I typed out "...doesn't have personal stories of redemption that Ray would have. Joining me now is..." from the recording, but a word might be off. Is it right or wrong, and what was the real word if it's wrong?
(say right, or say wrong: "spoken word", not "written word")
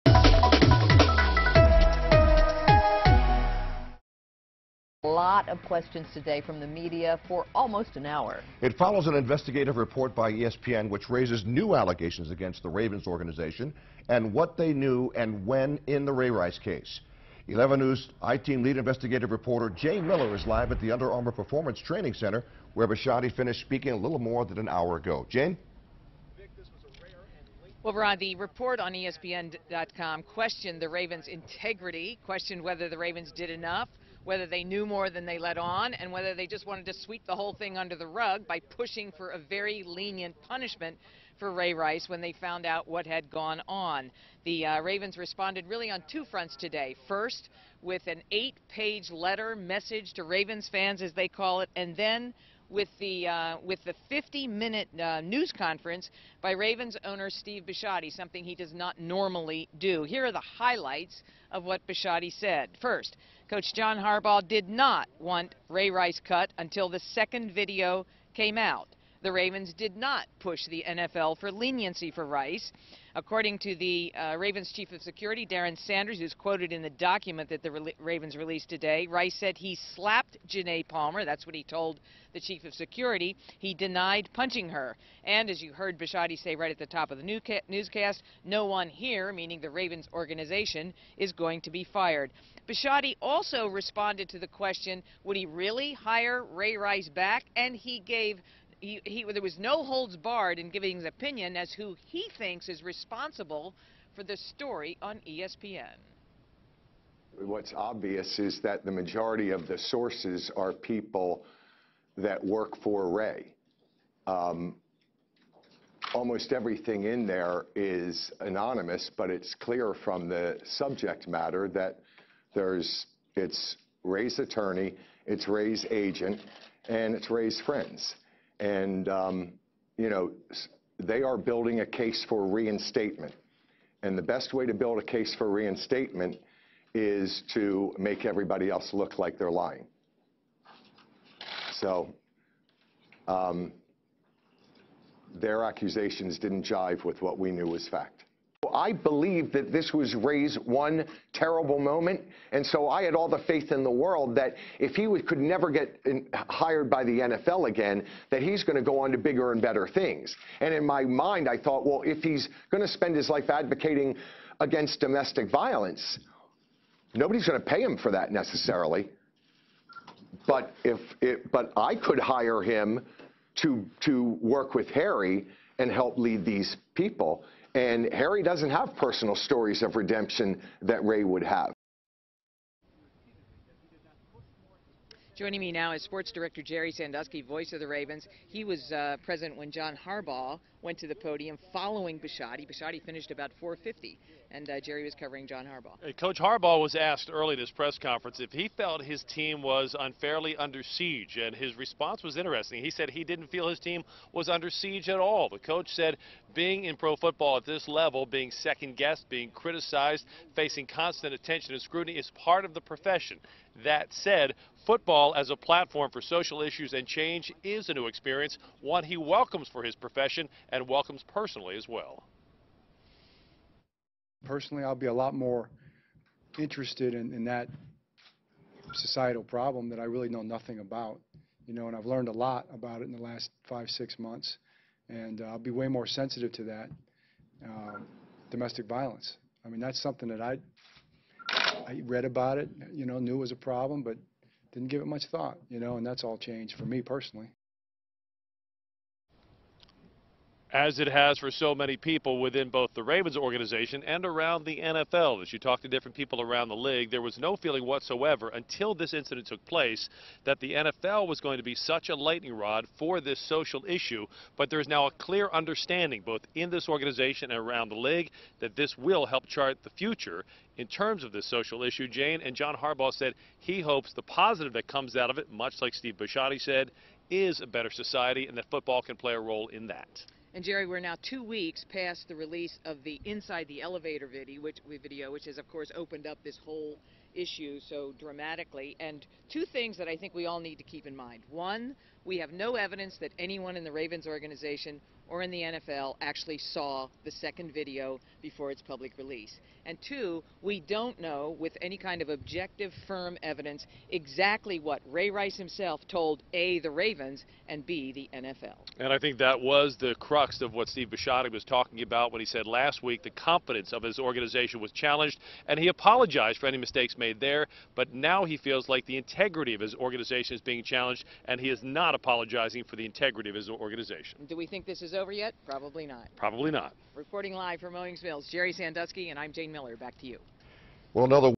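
right.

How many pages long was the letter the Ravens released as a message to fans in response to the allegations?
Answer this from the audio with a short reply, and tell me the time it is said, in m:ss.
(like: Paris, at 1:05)
8, at 0:48.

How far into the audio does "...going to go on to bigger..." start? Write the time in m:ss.
2:38.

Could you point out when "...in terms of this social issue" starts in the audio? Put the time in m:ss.
4:30.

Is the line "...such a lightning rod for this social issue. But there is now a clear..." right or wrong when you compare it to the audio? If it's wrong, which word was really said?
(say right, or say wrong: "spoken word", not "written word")
right.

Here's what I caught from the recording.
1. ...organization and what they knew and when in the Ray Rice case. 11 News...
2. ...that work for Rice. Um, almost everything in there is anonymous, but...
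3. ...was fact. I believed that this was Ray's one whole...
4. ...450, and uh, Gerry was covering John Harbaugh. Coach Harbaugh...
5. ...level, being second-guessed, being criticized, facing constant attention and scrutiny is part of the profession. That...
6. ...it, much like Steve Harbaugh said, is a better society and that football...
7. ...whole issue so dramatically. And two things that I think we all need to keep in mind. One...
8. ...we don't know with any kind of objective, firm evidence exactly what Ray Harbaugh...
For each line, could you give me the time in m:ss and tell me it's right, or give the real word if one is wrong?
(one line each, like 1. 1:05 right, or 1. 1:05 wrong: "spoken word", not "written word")
1. 0:13 right
2. 1:52 wrong: "Ray", not "Rice"
3. 2:27 wrong: "terrible", not "whole"
4. 3:13 right
5. 3:27 right
6. 4:35 wrong: "Bisciotti", not "Harbaugh"
7. 4:46 right
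8. 5:00 wrong: "Rice", not "Harbaugh".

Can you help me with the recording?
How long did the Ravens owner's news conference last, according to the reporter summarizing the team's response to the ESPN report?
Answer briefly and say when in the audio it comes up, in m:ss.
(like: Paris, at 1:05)
50 minutes, at 0:54.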